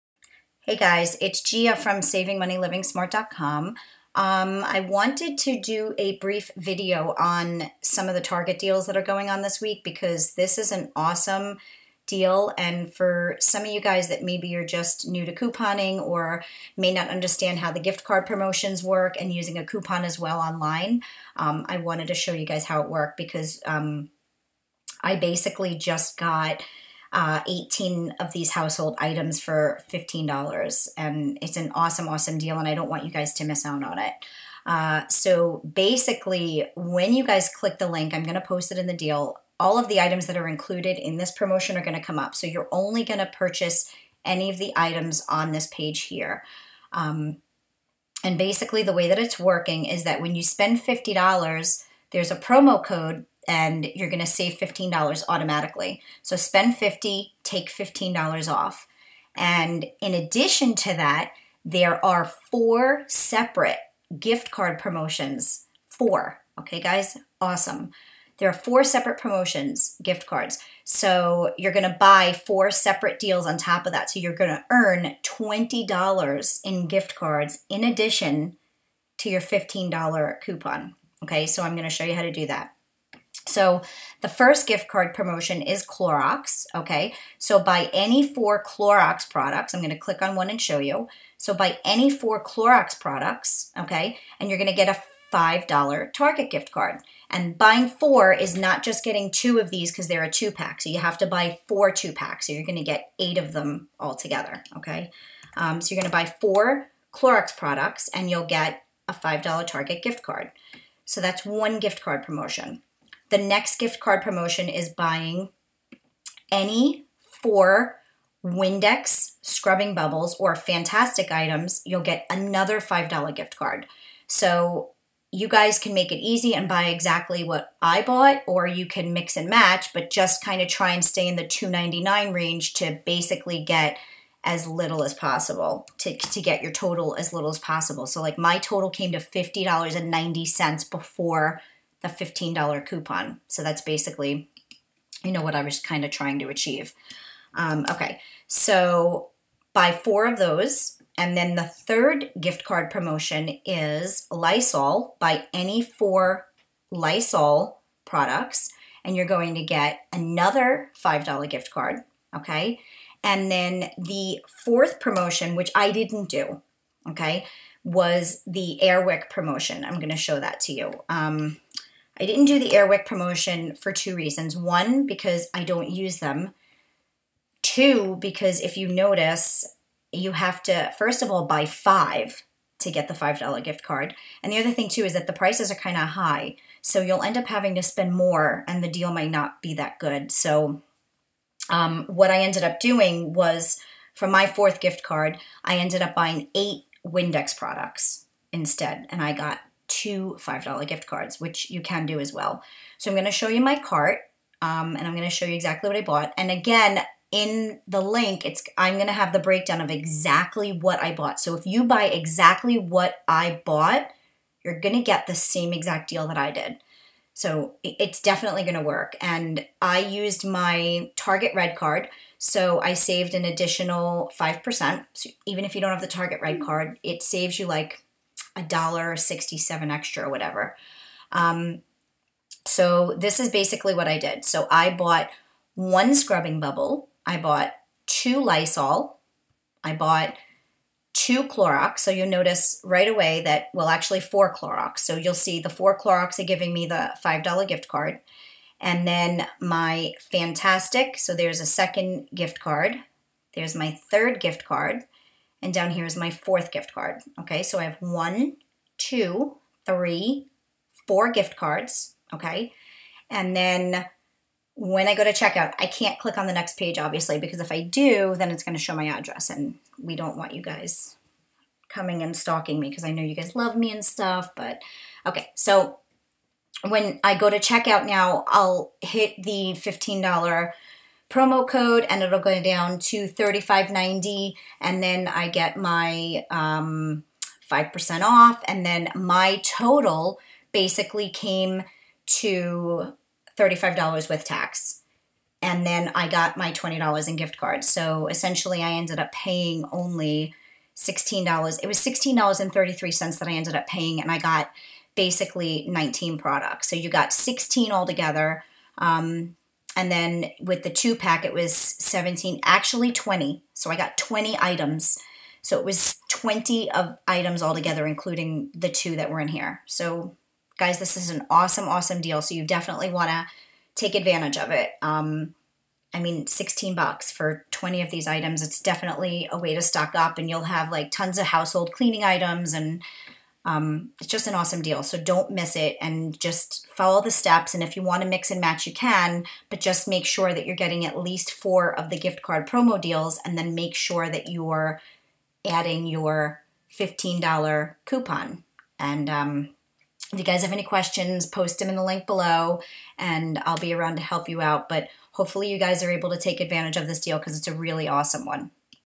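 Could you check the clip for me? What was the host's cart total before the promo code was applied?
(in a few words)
$50.90.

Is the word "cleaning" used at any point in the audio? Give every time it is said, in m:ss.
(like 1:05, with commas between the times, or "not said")
5:31.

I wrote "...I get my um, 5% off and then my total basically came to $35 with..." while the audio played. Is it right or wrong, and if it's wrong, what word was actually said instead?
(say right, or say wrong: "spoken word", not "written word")
right.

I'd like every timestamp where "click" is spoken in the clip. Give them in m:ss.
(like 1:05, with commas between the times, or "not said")
0:37, 1:29, 4:26.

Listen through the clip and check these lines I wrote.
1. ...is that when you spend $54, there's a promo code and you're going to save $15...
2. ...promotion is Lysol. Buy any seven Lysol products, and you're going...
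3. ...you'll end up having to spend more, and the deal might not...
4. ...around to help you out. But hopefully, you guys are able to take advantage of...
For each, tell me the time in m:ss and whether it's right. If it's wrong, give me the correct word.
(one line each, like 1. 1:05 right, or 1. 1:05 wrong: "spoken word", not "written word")
1. 0:49 wrong: "50", not "54"
2. 2:32 wrong: "four", not "seven"
3. 3:07 right
4. 5:53 right.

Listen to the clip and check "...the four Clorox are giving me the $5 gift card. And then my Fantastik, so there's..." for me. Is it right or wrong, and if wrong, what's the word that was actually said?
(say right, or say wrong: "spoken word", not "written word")
right.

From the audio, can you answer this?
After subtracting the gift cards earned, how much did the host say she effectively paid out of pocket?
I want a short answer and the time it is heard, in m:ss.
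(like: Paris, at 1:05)
$16.33, at 5:01.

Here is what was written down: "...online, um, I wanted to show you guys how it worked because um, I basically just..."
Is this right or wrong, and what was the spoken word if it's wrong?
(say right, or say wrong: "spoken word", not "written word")
right.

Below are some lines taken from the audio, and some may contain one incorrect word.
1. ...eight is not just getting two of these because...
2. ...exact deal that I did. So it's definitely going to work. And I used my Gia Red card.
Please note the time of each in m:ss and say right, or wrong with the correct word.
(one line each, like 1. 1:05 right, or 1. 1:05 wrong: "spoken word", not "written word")
1. 1:37 wrong: "four", not "eight"
2. 3:35 wrong: "Target", not "Gia".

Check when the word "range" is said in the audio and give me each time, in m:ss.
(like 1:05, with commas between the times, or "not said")
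2:12.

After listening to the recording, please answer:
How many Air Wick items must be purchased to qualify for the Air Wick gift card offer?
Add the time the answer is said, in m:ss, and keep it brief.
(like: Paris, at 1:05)
5, at 3:01.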